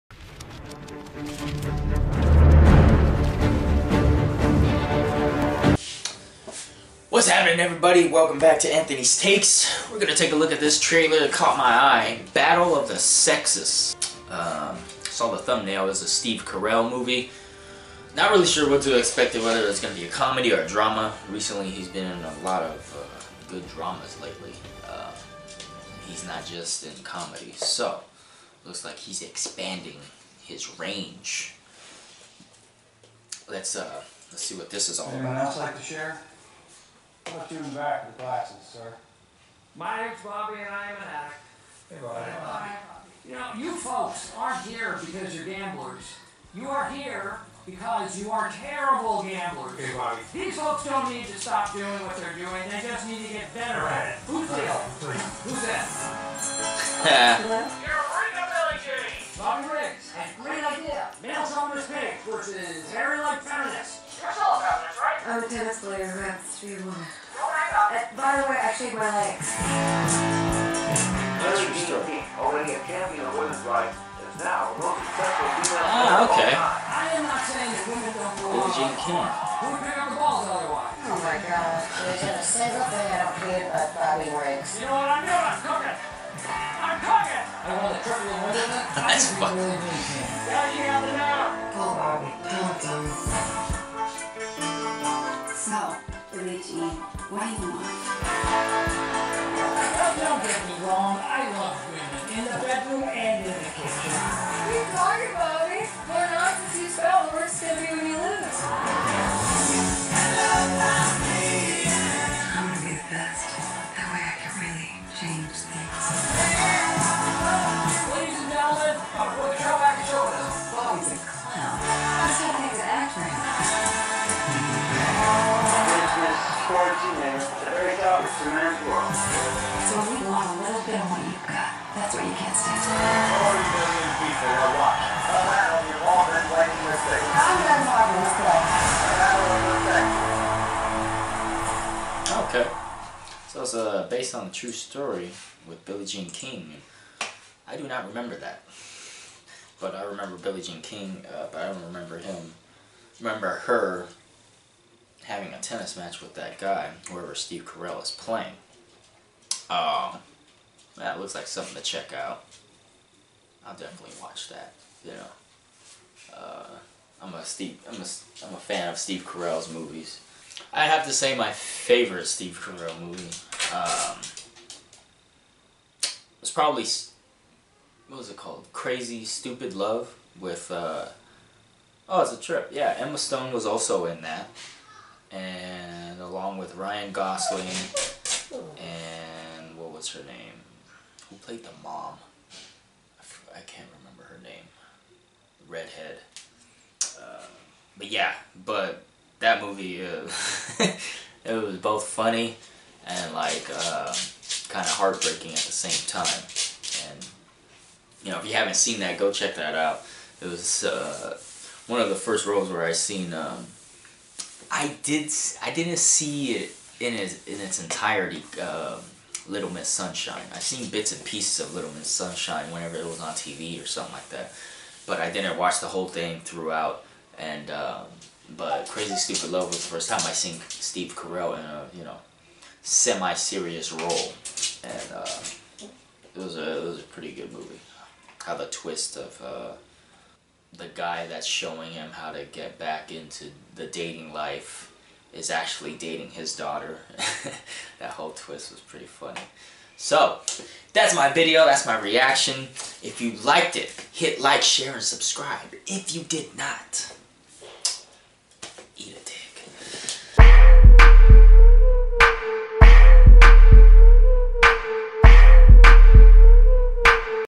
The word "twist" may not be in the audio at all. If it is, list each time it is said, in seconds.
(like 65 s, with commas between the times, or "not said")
238 s, 248 s.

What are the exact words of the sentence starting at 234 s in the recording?
And, uh, it was a, it was a pretty good movie.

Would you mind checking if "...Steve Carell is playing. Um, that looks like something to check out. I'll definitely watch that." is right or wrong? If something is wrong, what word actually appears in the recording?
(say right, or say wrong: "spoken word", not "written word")
right.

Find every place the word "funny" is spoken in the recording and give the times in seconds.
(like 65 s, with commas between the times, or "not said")
202 s, 249 s.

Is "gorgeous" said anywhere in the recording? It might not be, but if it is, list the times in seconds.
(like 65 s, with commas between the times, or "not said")
not said.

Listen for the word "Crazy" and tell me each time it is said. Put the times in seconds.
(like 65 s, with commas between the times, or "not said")
178 s, 228 s.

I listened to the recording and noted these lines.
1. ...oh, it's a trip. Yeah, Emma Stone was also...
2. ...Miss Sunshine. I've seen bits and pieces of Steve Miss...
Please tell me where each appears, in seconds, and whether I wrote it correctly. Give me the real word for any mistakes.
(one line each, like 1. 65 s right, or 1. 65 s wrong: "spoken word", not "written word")
1. 182 s right
2. 219 s wrong: "Little", not "Steve".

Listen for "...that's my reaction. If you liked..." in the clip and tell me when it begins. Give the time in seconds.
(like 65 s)
251 s.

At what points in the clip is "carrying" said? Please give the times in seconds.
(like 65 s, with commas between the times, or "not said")
not said.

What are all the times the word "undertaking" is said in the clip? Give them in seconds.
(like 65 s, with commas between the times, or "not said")
not said.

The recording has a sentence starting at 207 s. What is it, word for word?
And you know, if you haven't seen that, go check that out.